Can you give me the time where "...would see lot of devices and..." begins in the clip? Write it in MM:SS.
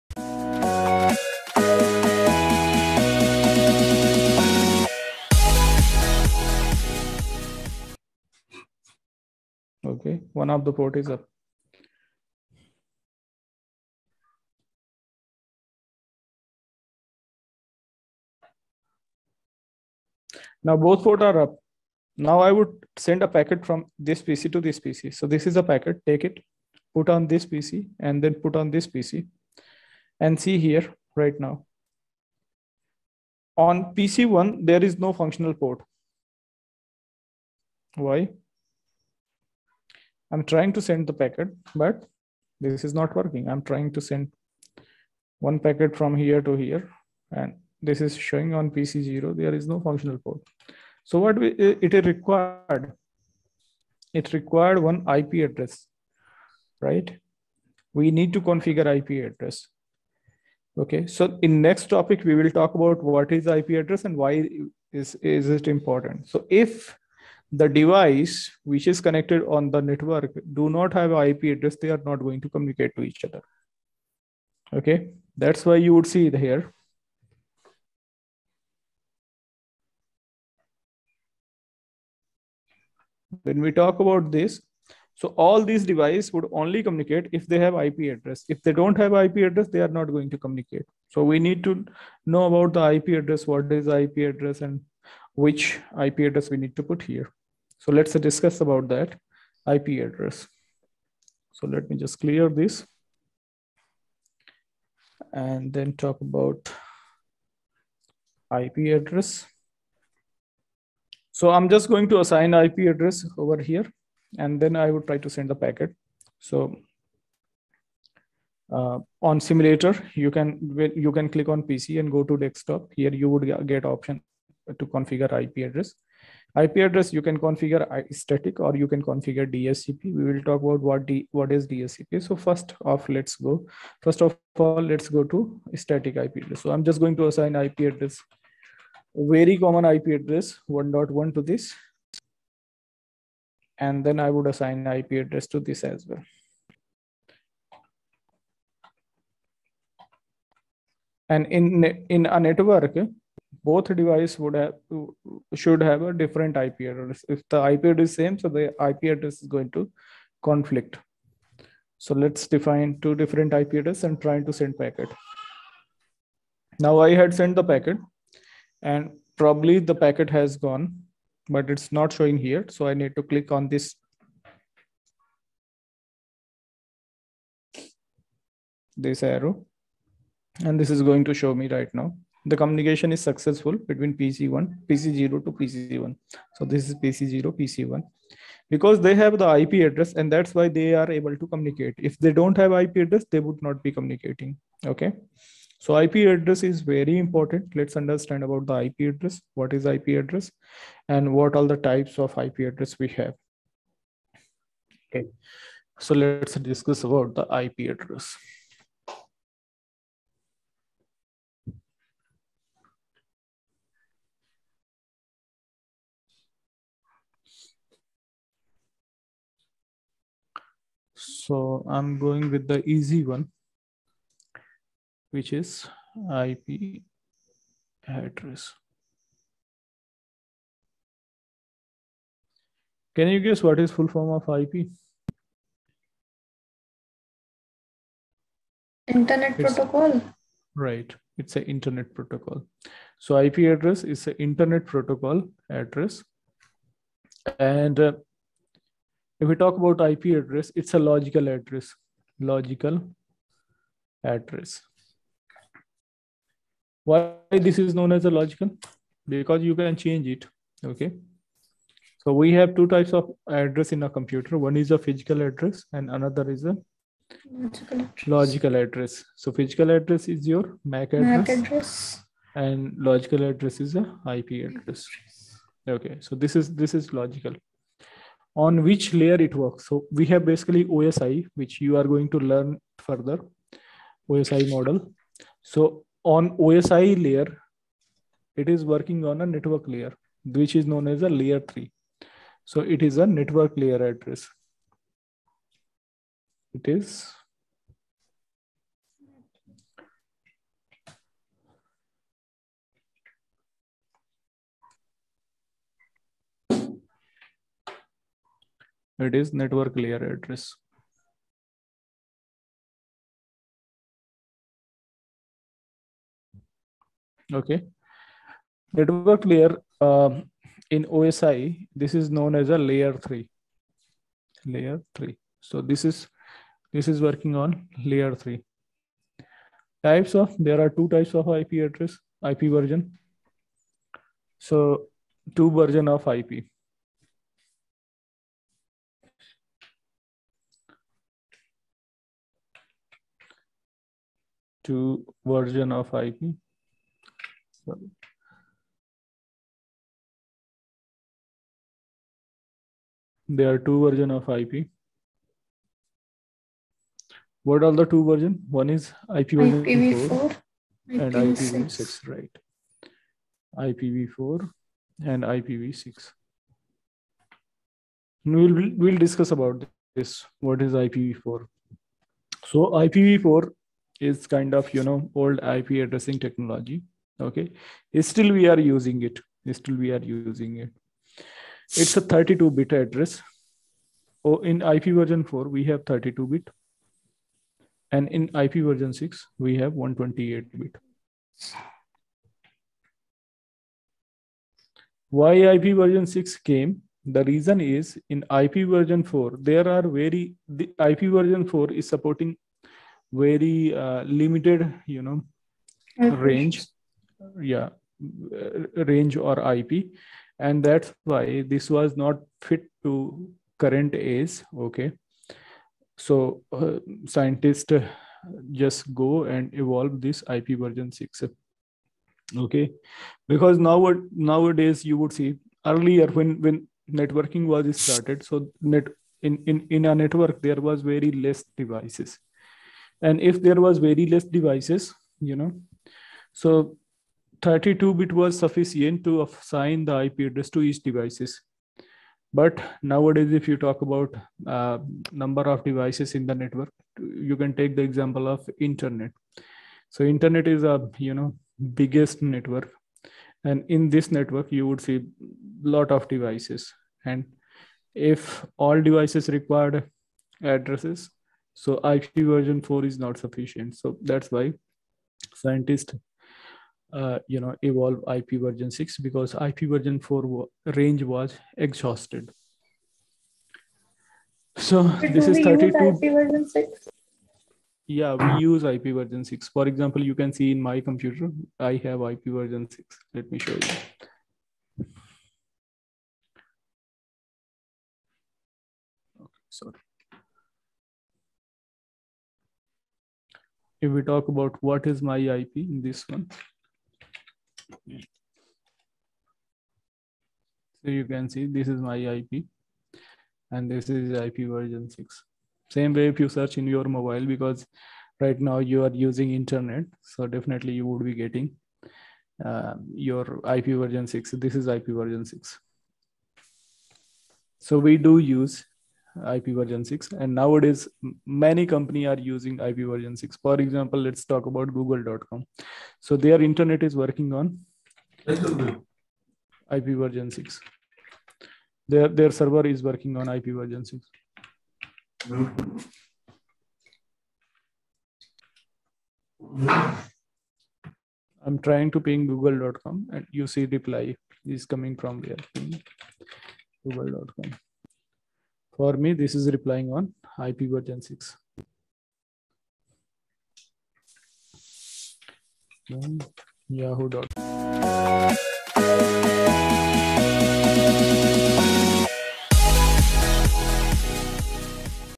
07:34.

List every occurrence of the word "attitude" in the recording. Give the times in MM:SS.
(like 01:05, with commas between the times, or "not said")
not said.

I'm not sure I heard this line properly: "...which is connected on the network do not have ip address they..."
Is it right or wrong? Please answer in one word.
right.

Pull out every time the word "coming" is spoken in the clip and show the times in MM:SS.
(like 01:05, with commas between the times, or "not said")
09:04.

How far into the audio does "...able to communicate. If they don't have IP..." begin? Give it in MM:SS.
03:11.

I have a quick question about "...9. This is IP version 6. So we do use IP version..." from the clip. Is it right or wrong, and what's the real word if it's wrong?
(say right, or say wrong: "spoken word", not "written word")
wrong: "6", not "9".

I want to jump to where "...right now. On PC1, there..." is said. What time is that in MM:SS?
00:31.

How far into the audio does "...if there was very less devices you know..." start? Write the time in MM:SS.
07:13.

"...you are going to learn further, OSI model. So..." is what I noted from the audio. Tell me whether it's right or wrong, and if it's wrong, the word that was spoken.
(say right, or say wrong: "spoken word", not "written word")
right.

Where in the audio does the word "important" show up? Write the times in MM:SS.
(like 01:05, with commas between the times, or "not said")
01:05, 03:17.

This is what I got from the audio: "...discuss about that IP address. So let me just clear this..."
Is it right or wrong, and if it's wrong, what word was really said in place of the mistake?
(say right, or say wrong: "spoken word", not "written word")
right.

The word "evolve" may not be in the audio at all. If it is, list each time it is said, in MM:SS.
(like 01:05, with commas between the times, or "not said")
06:59, 07:47.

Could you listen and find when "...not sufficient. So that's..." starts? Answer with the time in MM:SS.
07:43.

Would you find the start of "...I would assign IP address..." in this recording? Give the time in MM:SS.
02:24.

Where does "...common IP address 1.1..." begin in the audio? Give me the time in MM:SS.
02:19.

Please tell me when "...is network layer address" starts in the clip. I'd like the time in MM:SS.
05:09.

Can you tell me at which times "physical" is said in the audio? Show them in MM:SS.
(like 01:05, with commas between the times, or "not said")
04:24, 04:29.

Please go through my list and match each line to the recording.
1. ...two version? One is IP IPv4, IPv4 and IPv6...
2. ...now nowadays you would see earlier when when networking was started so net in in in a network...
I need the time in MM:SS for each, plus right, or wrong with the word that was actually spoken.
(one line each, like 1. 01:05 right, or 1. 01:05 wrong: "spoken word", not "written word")
1. 05:58 right
2. 07:03 right.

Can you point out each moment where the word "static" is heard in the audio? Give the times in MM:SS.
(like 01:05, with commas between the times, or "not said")
02:08, 02:15.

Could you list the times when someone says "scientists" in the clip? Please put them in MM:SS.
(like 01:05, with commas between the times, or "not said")
06:57, 07:45.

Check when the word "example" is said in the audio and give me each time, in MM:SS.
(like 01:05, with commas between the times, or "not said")
07:28, 07:59, 08:43.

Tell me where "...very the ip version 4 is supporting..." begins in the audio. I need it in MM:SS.
06:40.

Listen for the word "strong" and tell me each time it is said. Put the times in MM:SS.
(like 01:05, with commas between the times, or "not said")
not said.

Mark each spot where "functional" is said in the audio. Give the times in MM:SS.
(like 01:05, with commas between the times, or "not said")
00:35, 00:49.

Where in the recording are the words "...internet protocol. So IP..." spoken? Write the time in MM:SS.
04:01.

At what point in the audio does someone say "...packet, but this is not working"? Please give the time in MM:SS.
00:41.